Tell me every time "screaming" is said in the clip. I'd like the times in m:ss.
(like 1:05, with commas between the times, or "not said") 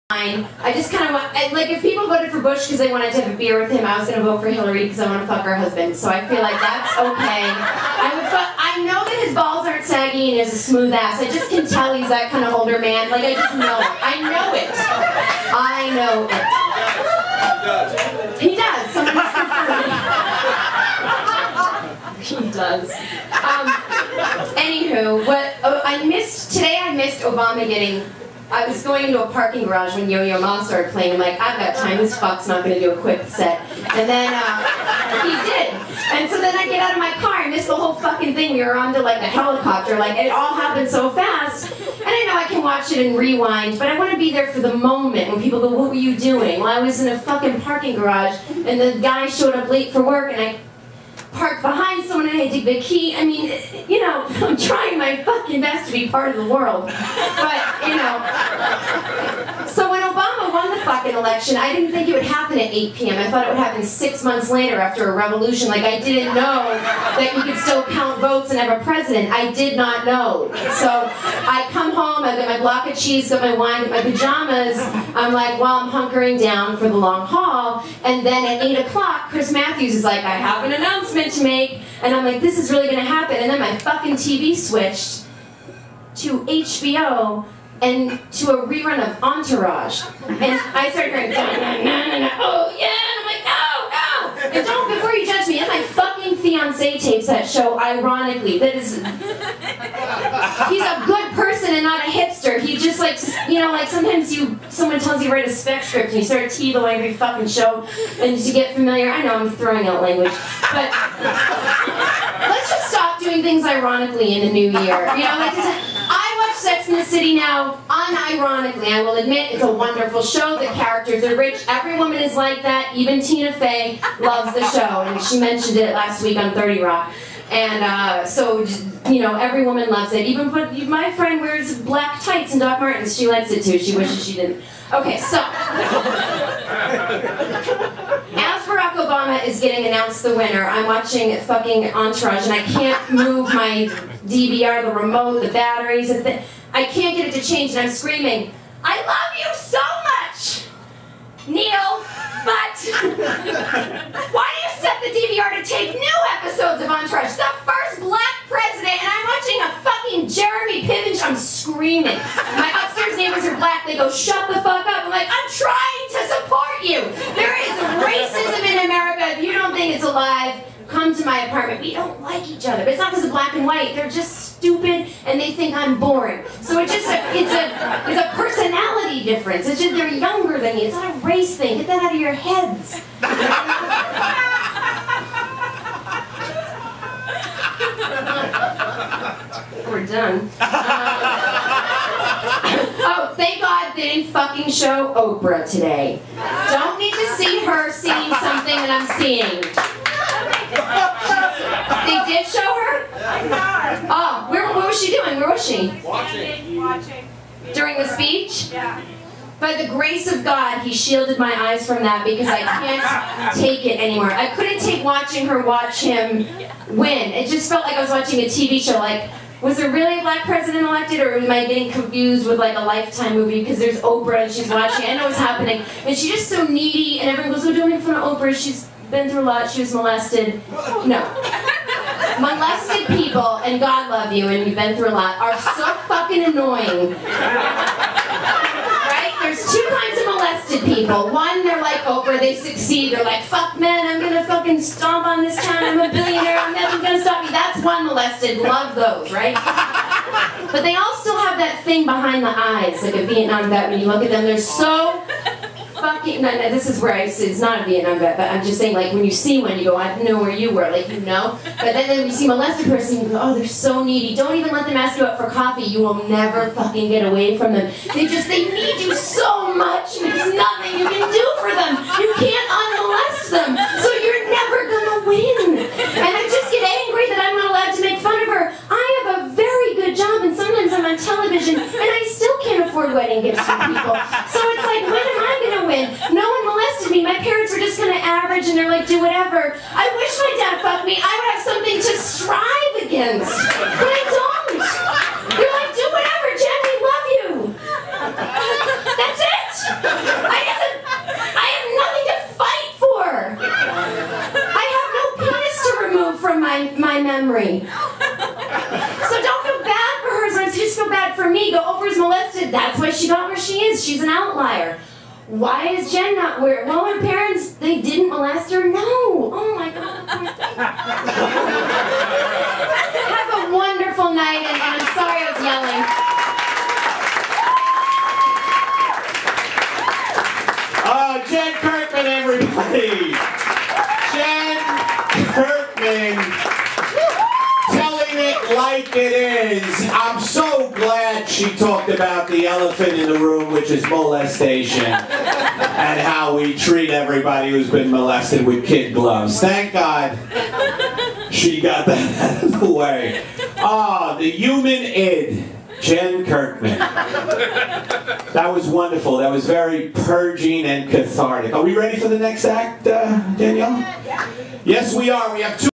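2:27, 2:41.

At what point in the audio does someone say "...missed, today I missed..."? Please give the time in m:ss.
0:26.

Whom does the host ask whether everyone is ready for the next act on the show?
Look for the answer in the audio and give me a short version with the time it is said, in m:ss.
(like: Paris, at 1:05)
Danielle, at 6:03.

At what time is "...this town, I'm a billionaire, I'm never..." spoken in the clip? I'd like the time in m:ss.
4:05.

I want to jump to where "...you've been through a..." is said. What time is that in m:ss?
3:54.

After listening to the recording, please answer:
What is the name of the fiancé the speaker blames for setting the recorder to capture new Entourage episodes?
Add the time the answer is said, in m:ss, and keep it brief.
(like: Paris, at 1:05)
Neil, at 2:31.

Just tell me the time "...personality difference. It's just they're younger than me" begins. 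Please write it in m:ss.
2:58.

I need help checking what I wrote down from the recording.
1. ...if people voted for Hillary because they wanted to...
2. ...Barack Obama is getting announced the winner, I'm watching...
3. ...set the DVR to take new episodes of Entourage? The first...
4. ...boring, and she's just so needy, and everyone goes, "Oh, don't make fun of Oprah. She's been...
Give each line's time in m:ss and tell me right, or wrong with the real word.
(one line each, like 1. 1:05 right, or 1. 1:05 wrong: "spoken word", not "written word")
1. 0:01 wrong: "Bush", not "Hillary"
2. 2:18 right
3. 2:34 right
4. 3:45 wrong: "happening", not "boring".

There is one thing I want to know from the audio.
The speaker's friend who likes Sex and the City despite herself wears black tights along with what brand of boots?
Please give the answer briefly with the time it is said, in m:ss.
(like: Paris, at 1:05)
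Doc Martens, at 2:12.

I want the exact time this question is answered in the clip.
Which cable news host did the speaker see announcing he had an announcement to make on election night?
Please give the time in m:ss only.
1:19.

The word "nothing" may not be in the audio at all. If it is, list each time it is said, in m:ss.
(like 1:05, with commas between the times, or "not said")
4:30, 5:01.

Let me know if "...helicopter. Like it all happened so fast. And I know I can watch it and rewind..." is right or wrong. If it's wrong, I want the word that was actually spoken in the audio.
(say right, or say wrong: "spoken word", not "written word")
right.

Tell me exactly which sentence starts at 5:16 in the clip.
Well, her parents, they didn't molest her.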